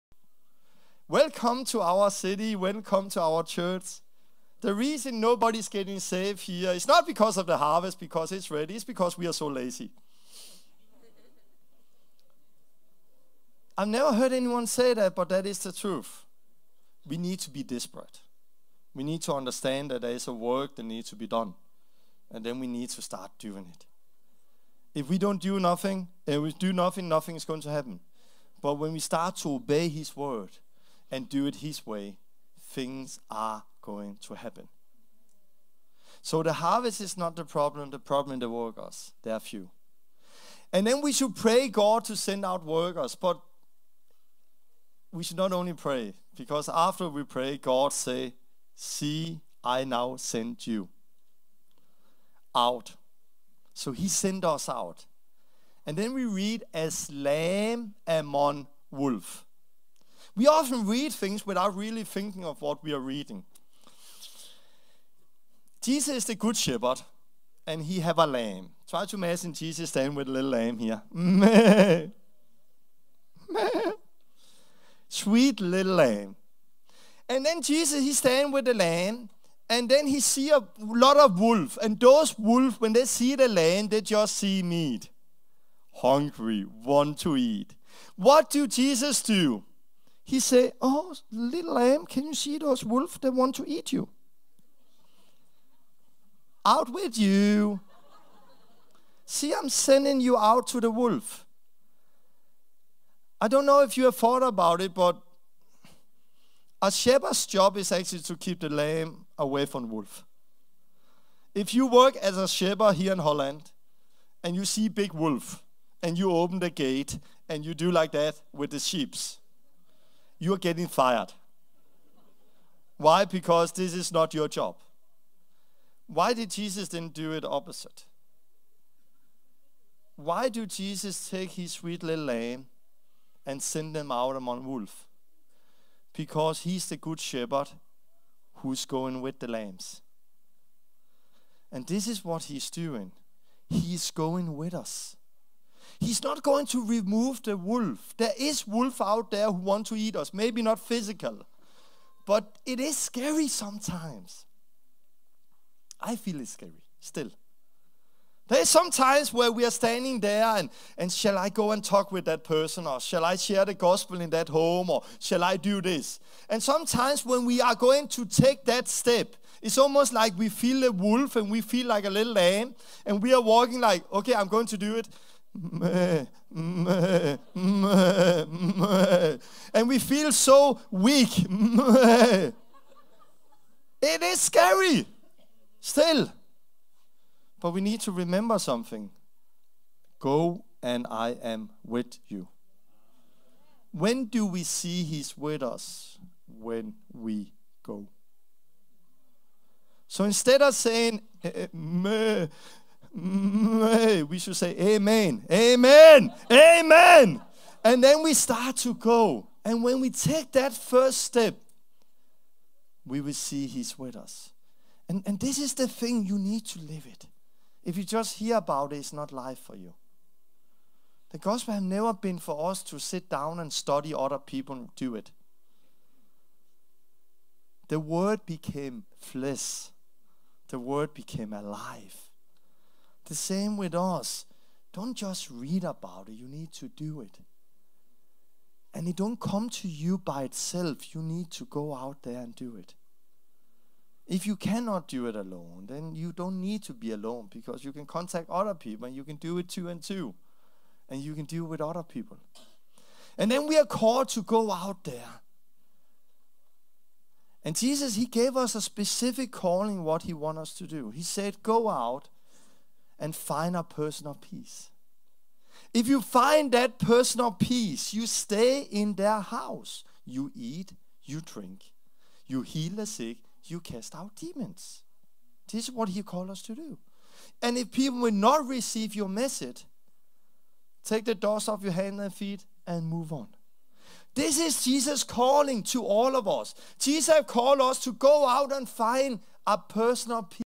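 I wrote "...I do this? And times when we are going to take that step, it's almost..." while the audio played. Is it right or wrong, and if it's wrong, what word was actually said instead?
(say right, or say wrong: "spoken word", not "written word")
wrong: "sometimes", not "times".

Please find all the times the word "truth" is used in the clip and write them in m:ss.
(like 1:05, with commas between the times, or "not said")
0:15.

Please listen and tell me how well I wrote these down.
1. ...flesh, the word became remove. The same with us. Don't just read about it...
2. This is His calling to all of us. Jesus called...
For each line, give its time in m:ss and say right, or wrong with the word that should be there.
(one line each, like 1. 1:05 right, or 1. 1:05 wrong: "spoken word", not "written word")
1. 3:49 wrong: "alive", not "remove"
2. 4:44 wrong: "Jesus", not "His".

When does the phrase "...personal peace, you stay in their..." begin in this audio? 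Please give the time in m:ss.
4:26.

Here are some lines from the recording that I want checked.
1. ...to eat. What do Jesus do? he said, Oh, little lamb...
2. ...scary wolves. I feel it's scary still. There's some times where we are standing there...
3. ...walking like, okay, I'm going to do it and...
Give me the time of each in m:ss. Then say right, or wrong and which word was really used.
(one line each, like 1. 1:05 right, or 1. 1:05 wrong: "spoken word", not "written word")
1. 1:27 right
2. 2:32 wrong: "sometimes", not "wolves"
3. 2:53 right.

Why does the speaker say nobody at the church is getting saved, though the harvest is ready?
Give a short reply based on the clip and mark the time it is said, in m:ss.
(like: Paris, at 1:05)
We are so lazy, at 0:09.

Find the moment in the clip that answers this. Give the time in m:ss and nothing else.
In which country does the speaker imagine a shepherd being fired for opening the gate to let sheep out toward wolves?
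1:53.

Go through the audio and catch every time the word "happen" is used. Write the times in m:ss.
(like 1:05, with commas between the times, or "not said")
0:27, 0:34.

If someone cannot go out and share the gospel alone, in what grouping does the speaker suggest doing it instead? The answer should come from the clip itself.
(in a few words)
Two and two.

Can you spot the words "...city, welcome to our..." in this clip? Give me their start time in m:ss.
0:02.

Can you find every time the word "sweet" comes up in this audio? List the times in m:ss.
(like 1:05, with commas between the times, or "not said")
1:15, 2:11.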